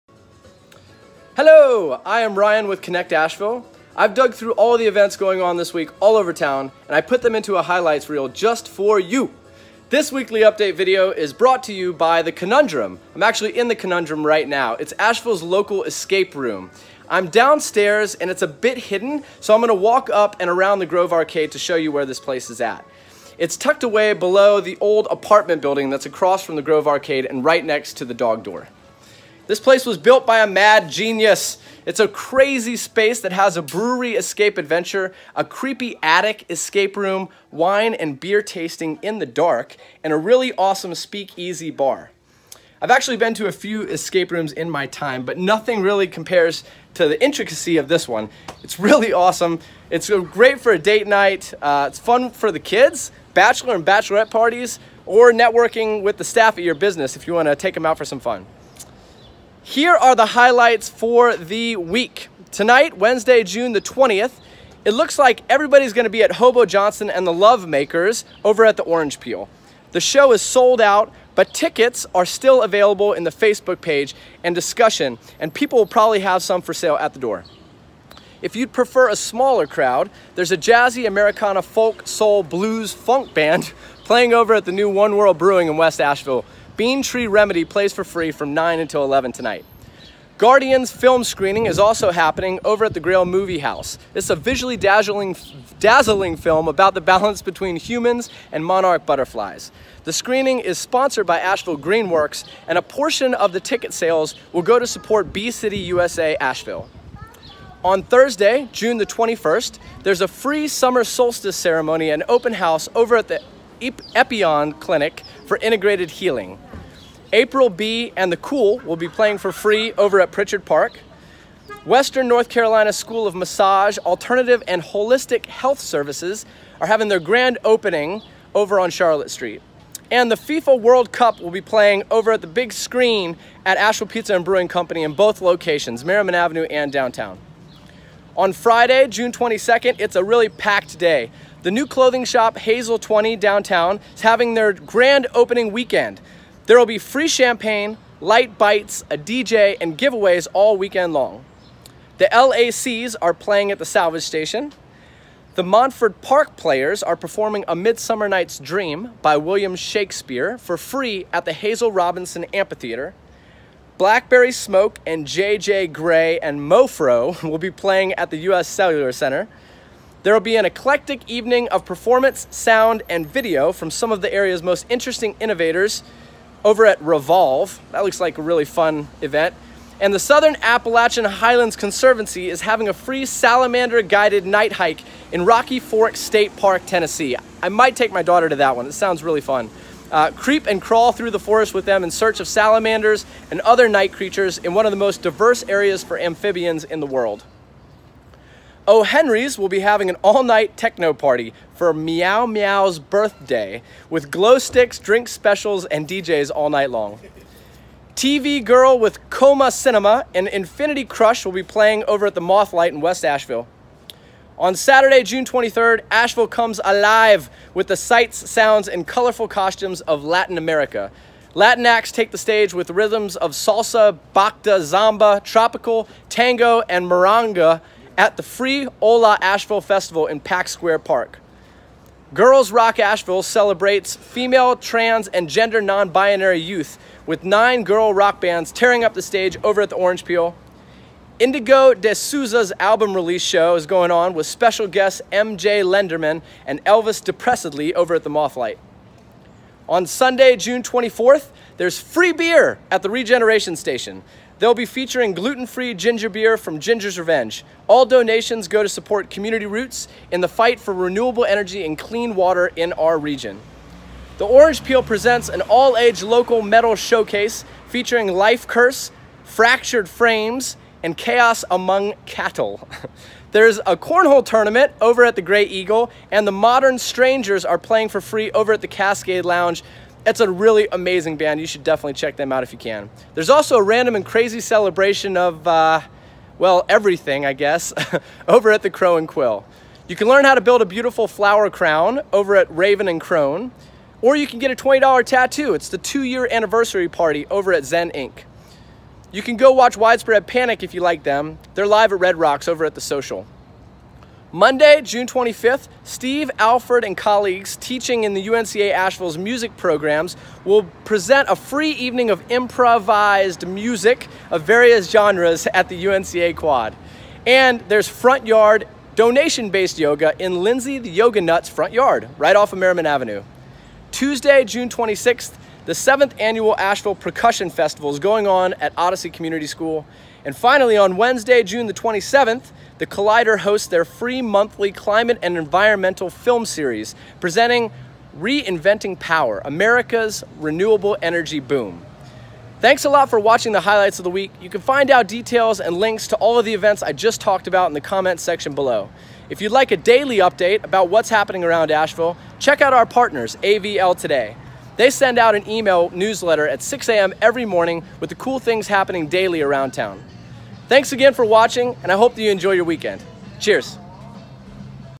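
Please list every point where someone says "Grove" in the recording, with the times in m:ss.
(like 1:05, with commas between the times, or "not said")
0:20, 0:26.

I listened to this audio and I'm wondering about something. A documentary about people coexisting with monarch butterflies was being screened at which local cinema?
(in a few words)
Grail Movie House.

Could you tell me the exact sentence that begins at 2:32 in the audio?
The LACs are playing at the salvage station.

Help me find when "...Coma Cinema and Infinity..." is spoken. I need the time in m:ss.
3:29.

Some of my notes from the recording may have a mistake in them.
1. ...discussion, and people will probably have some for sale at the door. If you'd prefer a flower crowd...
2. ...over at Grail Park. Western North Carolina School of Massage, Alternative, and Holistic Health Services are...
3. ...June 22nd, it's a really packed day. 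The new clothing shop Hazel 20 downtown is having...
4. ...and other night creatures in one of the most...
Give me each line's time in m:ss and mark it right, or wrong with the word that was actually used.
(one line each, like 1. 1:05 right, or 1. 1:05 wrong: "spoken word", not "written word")
1. 1:14 wrong: "smaller", not "flower"
2. 1:59 wrong: "Pritchard", not "Grail"
3. 2:19 right
4. 3:13 right.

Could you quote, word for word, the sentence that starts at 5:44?
You can find out details and links to all of the events I just talked about in the comments section below.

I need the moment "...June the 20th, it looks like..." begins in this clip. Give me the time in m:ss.
1:03.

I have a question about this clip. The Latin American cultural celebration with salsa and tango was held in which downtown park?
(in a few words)
Pack Square Park.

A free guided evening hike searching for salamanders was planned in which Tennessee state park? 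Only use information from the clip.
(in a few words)
Rocky Fork State Park.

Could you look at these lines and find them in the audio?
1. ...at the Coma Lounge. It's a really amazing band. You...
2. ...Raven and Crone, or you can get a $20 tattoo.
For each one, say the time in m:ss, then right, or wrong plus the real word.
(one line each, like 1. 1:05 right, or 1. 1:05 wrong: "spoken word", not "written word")
1. 4:38 wrong: "Cascade", not "Coma"
2. 4:52 right.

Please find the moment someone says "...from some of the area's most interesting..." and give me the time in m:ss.
2:53.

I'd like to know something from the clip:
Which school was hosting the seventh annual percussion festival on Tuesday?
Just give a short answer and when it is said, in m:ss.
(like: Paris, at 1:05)
Odyssey Community School, at 5:28.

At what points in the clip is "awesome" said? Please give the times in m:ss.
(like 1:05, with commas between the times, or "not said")
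0:40, 0:49.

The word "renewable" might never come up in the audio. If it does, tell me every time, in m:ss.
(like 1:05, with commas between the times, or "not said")
4:20, 5:40.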